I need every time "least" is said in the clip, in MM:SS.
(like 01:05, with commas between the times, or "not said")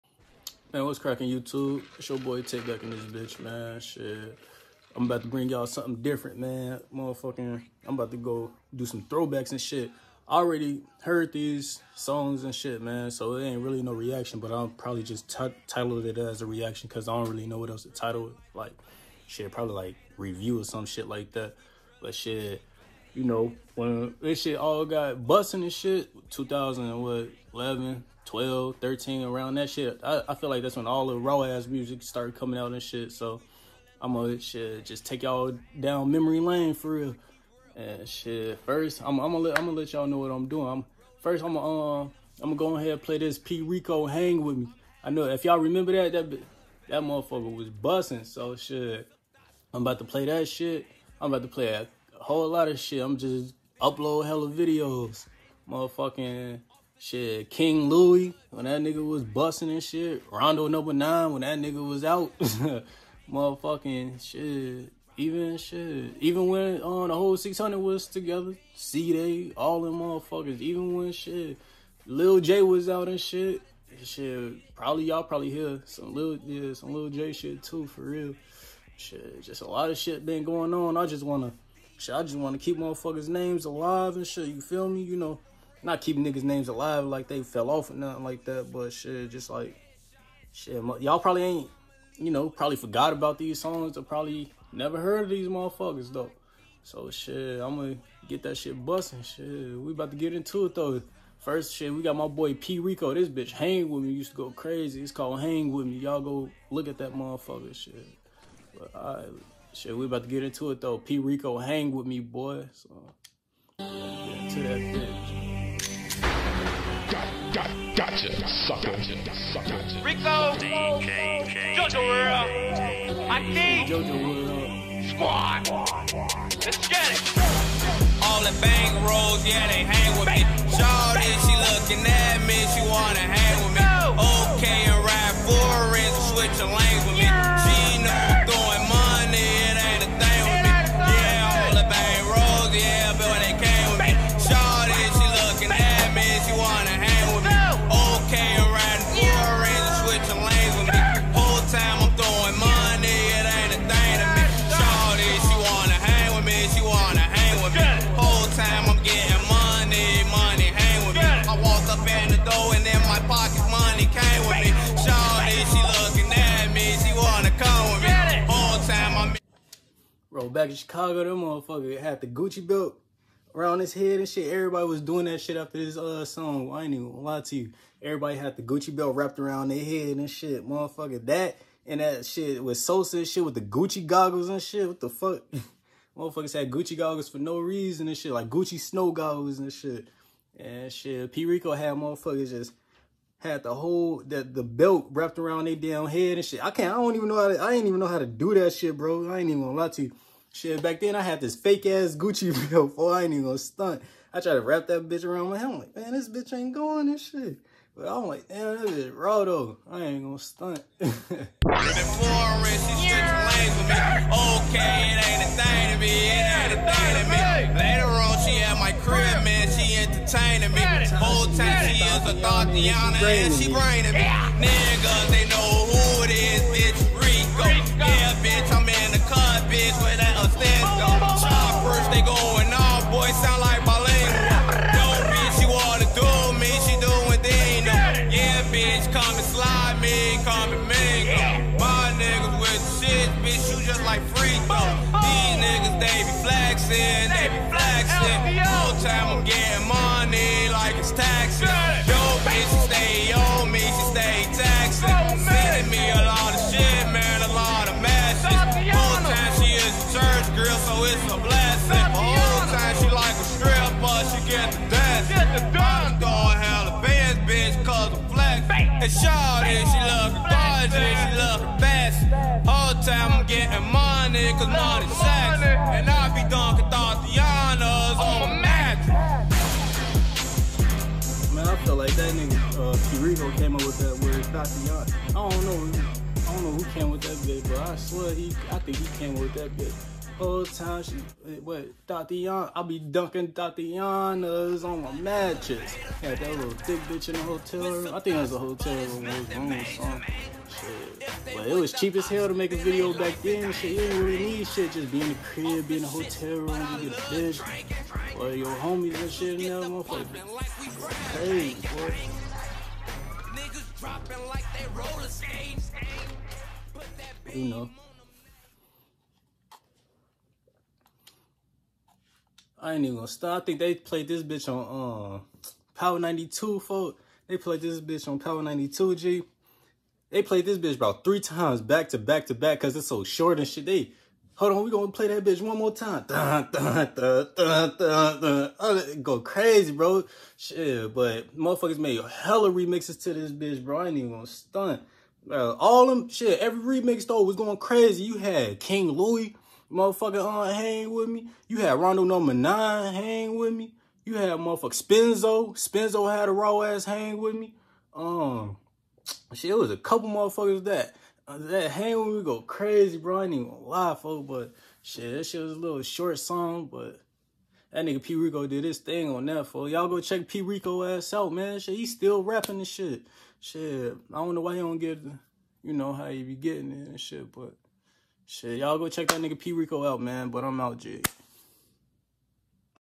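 not said.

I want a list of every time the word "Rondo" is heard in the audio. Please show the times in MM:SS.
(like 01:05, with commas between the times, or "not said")
01:00, 05:51.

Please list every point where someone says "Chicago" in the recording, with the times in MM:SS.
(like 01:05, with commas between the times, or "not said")
02:50.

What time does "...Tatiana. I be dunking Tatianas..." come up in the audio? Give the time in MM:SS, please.
04:52.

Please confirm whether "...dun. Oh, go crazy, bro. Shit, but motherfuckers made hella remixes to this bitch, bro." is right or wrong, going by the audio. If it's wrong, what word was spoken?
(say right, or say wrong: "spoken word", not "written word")
right.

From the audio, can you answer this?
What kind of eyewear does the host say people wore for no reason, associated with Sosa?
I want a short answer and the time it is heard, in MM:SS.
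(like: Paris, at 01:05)
Gucci snow goggles, at 03:08.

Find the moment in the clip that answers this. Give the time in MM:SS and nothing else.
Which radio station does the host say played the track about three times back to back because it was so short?
05:28.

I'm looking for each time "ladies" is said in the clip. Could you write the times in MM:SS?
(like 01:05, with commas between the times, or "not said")
not said.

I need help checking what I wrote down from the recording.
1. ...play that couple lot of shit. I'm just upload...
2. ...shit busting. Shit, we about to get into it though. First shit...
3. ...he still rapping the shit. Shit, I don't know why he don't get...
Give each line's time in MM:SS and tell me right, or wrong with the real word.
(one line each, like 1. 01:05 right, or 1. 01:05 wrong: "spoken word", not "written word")
1. 00:51 wrong: "whole", not "couple"
2. 01:38 right
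3. 06:11 right.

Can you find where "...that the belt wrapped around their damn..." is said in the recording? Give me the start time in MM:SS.
03:14.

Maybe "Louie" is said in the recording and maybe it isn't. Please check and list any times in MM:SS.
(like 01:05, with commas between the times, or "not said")
00:57, 05:49.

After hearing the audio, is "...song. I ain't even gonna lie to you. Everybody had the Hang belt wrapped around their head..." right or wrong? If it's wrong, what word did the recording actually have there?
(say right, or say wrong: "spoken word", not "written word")
wrong: "Gucci", not "Hang".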